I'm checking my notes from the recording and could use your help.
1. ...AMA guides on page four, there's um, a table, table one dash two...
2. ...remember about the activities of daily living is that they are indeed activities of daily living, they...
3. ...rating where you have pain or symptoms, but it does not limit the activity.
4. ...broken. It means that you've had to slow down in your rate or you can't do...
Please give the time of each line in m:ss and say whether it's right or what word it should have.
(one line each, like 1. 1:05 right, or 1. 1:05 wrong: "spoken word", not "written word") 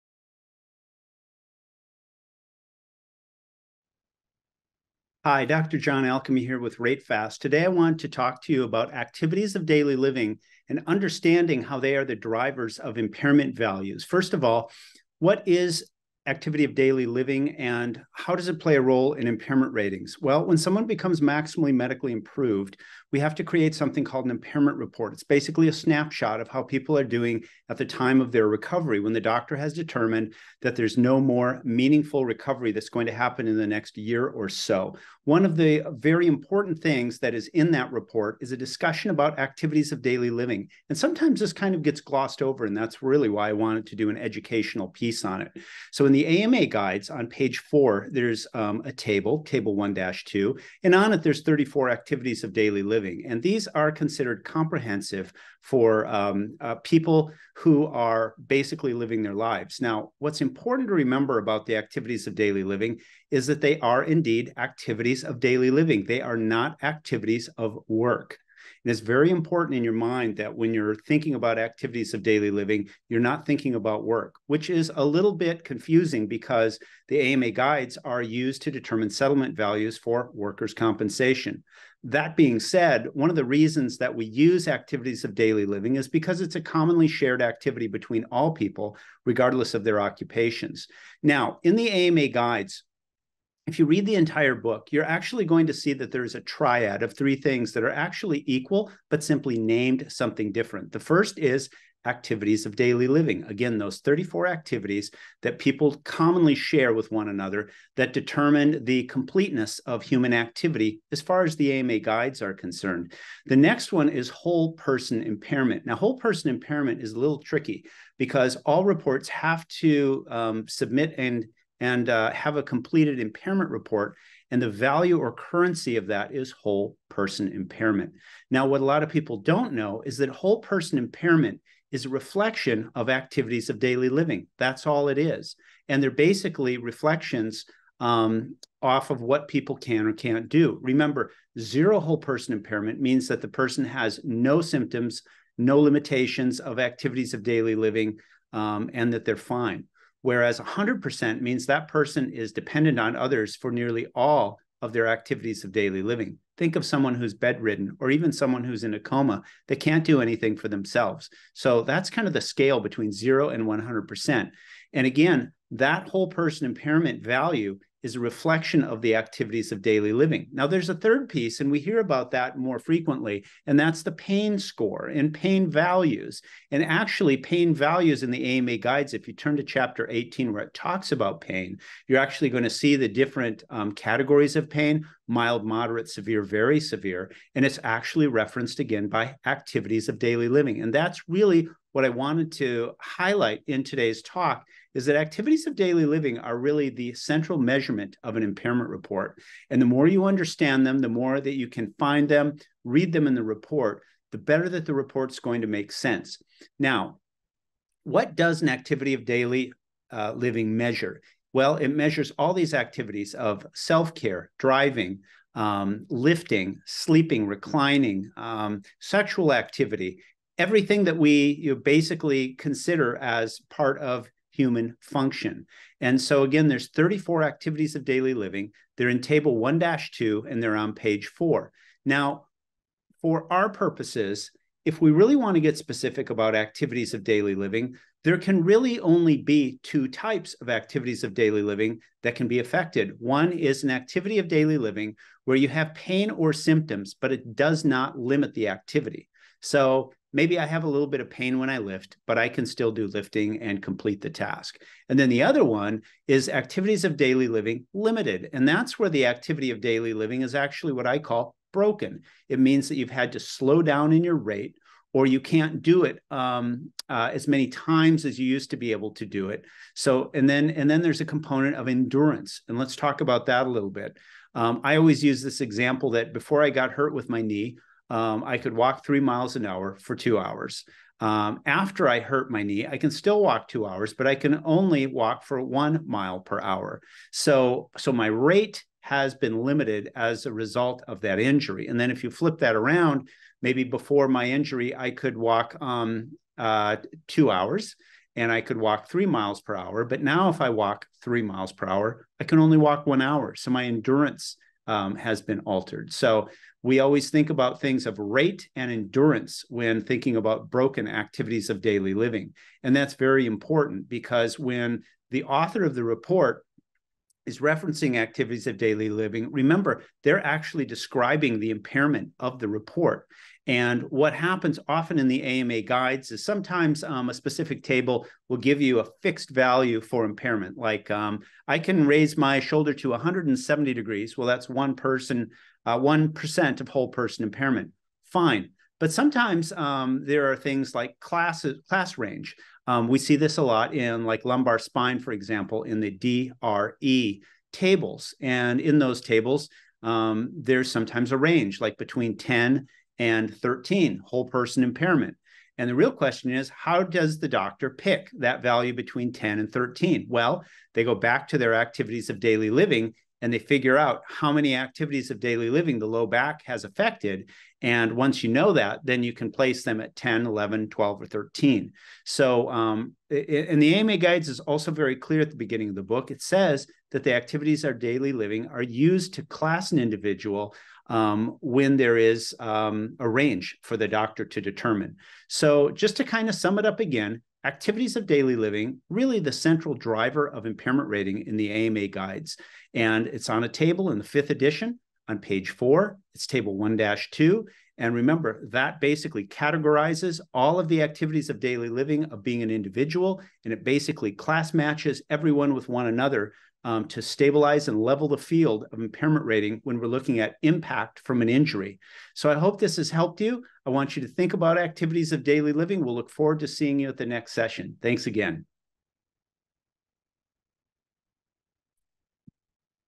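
1. 0:46 right
2. 1:00 right
3. 4:04 wrong: "living", not "rating"
4. 4:21 right.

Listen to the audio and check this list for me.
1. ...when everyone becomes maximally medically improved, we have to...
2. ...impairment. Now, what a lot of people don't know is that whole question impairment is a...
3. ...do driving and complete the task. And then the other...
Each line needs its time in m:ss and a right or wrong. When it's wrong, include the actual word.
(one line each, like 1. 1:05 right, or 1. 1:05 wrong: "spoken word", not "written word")
1. 0:20 wrong: "someone", not "everyone"
2. 2:07 wrong: "person", not "question"
3. 4:12 wrong: "lifting", not "driving".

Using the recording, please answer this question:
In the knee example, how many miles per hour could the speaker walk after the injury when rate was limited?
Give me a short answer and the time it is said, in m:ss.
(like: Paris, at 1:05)
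1, at 4:45.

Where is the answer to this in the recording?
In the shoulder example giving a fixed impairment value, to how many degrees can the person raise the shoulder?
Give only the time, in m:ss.
5:33.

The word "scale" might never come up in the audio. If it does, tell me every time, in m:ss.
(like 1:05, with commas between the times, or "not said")
2:42.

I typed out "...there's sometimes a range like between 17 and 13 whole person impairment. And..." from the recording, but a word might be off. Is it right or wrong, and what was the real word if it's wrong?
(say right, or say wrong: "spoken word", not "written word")
wrong: "10", not "17".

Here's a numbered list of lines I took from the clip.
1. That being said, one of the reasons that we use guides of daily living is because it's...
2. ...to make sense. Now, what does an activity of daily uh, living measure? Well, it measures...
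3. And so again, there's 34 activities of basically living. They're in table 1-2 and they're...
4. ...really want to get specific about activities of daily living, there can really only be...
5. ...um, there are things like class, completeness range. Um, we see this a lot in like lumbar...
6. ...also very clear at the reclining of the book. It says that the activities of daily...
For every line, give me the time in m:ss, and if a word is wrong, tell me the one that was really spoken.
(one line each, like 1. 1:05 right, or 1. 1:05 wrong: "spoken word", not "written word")
1. 1:22 wrong: "activities", not "guides"
2. 3:25 right
3. 3:45 wrong: "daily", not "basically"
4. 3:55 right
5. 5:39 wrong: "class", not "completeness"
6. 6:14 wrong: "beginning", not "reclining".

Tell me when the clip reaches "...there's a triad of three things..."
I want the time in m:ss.
1:36.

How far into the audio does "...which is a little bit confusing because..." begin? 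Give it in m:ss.
1:14.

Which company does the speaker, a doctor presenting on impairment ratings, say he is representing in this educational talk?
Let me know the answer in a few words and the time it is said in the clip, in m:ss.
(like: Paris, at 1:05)
RateFast, at 0:06.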